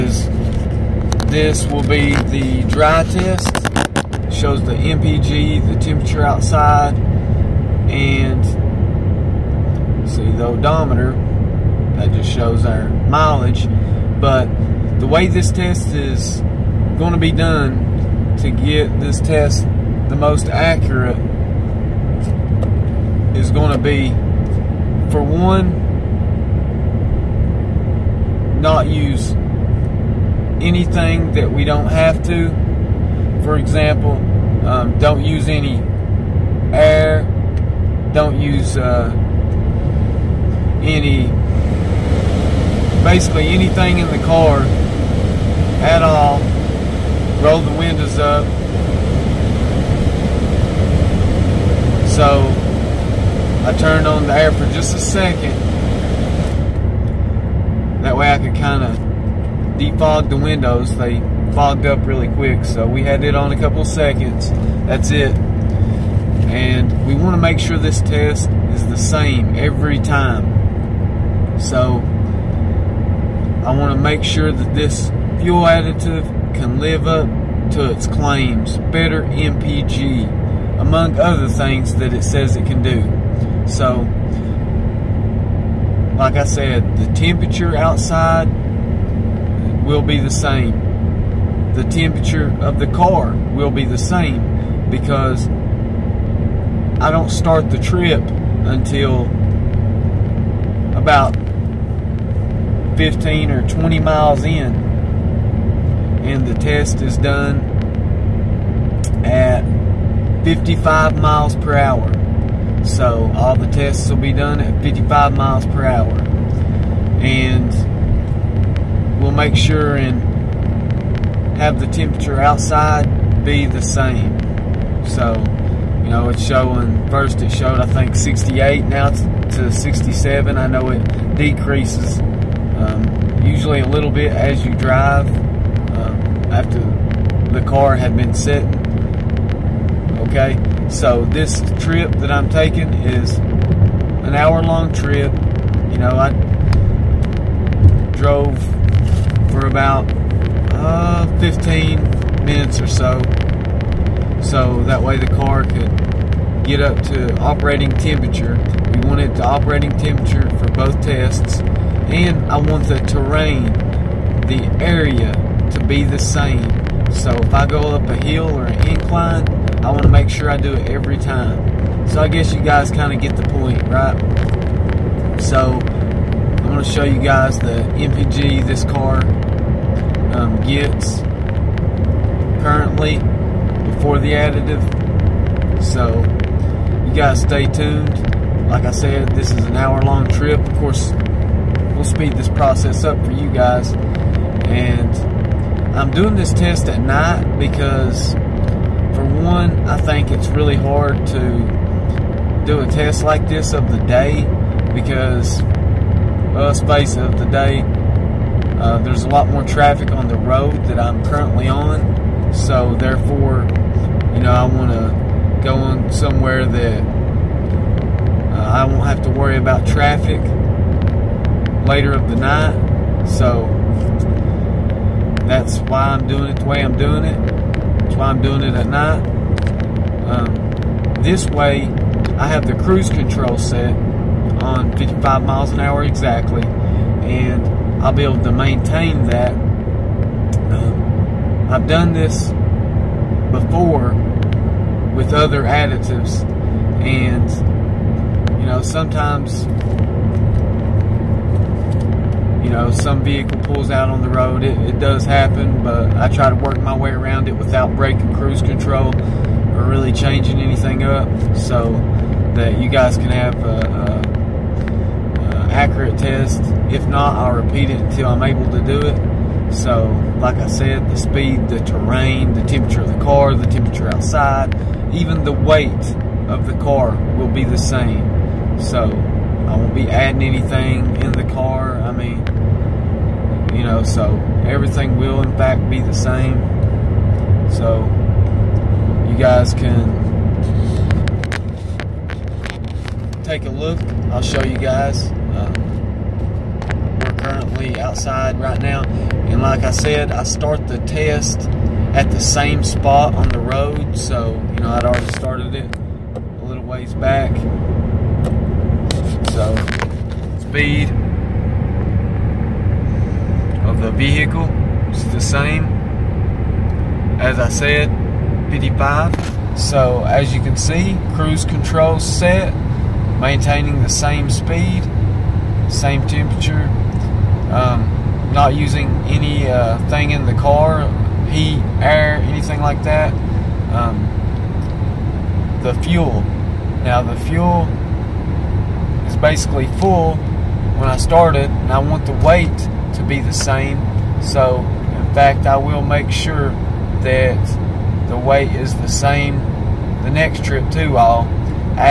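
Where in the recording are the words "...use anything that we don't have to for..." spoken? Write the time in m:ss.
0:28.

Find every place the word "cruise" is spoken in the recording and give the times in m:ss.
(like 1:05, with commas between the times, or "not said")
3:52, 4:18, 5:21.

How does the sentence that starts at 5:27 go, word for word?
Um, not using any uh, thing in the car, heat, air, anything like that.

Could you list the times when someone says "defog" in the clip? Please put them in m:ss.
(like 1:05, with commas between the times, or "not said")
0:59.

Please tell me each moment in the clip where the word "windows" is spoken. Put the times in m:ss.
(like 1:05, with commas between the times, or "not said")
0:47, 1:00.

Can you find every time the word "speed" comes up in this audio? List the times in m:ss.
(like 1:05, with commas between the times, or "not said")
3:12, 4:31, 5:10, 5:24.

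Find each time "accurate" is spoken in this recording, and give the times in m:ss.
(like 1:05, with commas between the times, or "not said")
0:20, 4:25.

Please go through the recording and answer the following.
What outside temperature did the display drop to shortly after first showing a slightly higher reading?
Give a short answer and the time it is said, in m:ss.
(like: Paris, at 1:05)
67, at 2:09.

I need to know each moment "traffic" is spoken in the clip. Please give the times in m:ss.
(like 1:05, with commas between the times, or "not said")
3:29, 3:39.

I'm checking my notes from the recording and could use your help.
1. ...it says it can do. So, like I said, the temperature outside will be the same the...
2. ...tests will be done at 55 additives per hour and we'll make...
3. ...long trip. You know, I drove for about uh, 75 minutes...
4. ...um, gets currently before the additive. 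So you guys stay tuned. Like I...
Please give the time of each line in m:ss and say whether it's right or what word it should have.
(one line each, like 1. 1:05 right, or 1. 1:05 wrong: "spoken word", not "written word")
1. 1:22 right
2. 1:53 wrong: "miles", not "additives"
3. 2:24 wrong: "15", not "75"
4. 3:00 right.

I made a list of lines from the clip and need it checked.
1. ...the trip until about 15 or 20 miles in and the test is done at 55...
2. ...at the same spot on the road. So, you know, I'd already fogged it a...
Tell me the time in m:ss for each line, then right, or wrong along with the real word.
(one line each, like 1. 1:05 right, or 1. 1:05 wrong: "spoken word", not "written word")
1. 1:37 right
2. 5:02 wrong: "started", not "fogged".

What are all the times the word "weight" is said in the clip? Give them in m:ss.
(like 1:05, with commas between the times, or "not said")
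4:35, 5:42, 5:48.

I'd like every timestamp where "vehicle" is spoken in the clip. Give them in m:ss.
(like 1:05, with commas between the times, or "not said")
4:13, 5:14.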